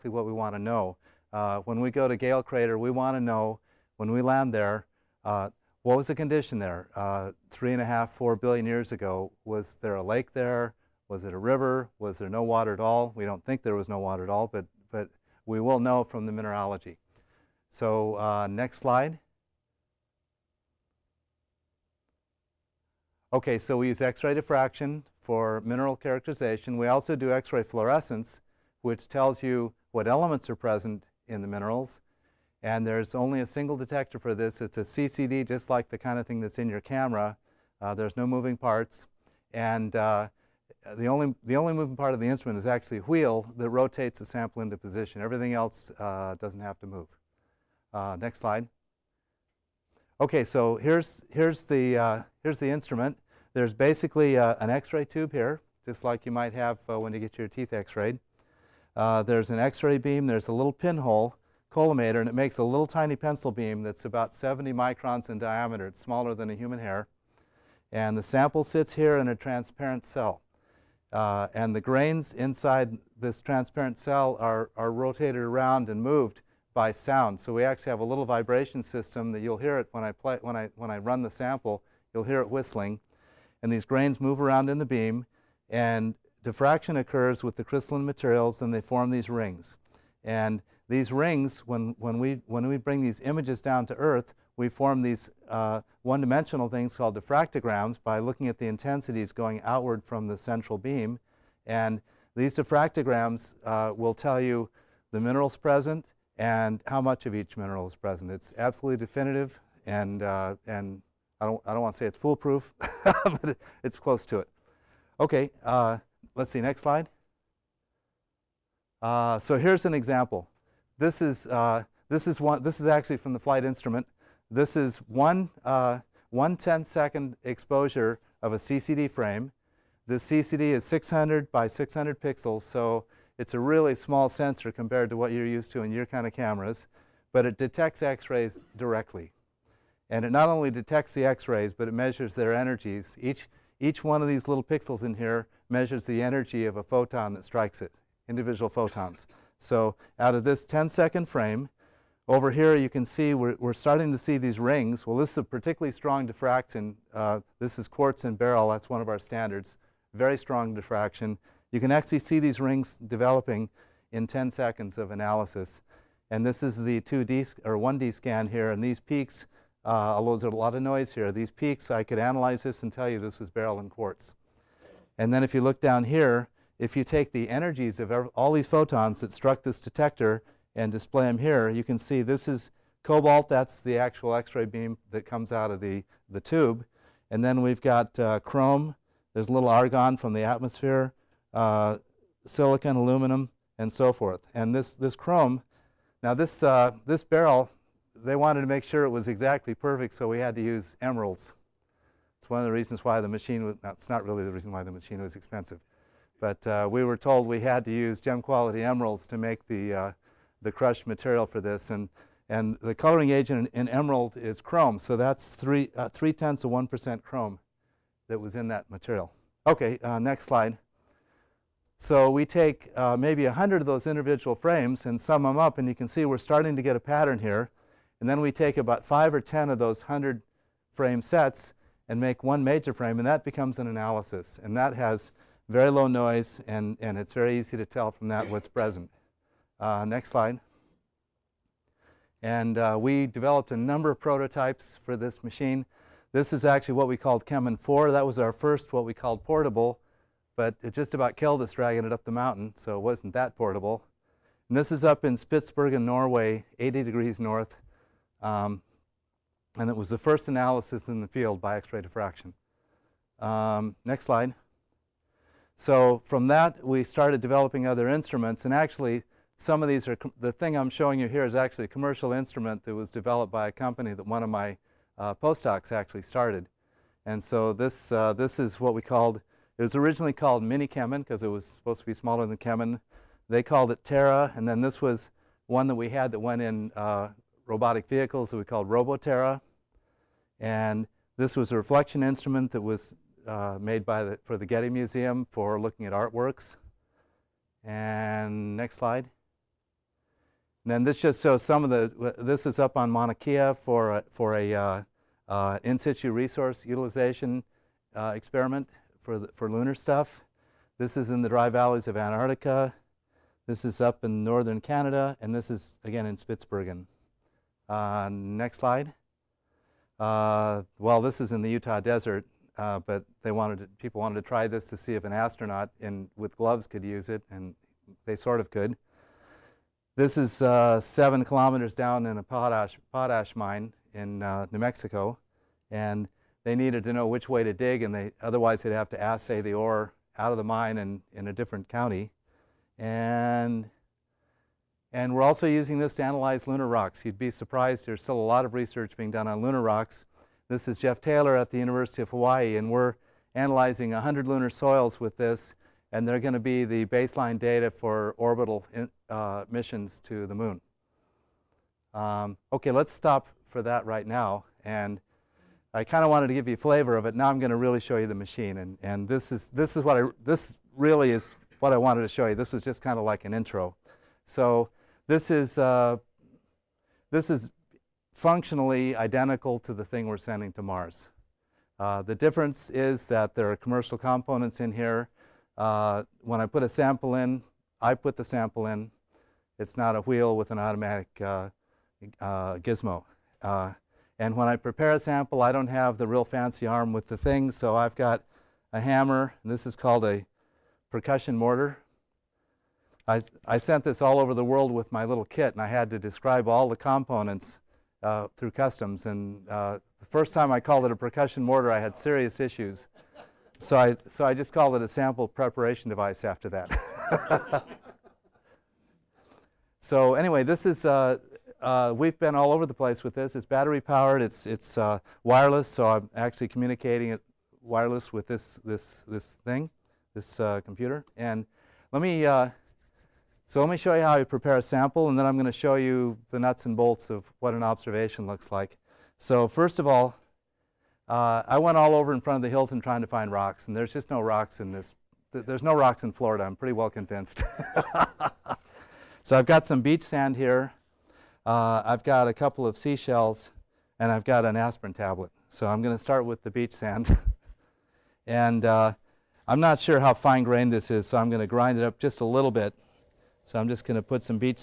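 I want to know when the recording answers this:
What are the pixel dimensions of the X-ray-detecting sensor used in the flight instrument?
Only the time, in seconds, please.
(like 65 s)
130 s.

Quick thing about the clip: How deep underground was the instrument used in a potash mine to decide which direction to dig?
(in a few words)
7 kilometers.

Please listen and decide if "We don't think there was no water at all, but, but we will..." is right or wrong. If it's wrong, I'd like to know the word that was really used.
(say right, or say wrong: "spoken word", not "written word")
right.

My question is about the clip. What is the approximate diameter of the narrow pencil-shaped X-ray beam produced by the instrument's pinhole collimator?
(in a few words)
70 microns.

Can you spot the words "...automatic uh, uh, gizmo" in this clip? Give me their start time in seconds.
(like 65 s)
390 s.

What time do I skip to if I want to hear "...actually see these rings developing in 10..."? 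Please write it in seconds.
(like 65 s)
161 s.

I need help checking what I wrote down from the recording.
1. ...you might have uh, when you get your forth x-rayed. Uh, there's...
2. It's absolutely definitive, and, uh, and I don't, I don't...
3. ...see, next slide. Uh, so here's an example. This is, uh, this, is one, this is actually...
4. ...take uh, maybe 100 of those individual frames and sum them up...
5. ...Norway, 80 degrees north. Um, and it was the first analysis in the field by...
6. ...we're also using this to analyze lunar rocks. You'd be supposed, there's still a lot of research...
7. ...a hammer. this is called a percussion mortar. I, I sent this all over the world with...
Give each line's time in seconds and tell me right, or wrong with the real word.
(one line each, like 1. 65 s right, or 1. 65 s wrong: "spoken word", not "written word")
1. 56 s wrong: "teeth", not "forth"
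2. 108 s right
3. 116 s right
4. 222 s right
5. 256 s right
6. 345 s wrong: "surprised", not "supposed"
7. 398 s right.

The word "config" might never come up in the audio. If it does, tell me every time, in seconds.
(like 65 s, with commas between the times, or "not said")
not said.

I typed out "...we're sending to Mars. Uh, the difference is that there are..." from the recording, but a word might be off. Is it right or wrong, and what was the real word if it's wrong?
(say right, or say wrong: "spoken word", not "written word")
right.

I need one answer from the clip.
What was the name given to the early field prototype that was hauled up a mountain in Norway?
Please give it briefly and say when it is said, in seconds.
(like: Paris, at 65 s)
CheMin 4, at 247 s.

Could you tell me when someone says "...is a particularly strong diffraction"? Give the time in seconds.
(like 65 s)
155 s.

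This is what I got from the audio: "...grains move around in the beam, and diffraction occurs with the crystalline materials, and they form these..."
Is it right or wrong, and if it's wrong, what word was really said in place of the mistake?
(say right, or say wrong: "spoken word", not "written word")
right.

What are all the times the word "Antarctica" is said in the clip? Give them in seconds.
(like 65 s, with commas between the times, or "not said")
312 s.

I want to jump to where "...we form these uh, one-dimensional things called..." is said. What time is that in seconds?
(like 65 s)
94 s.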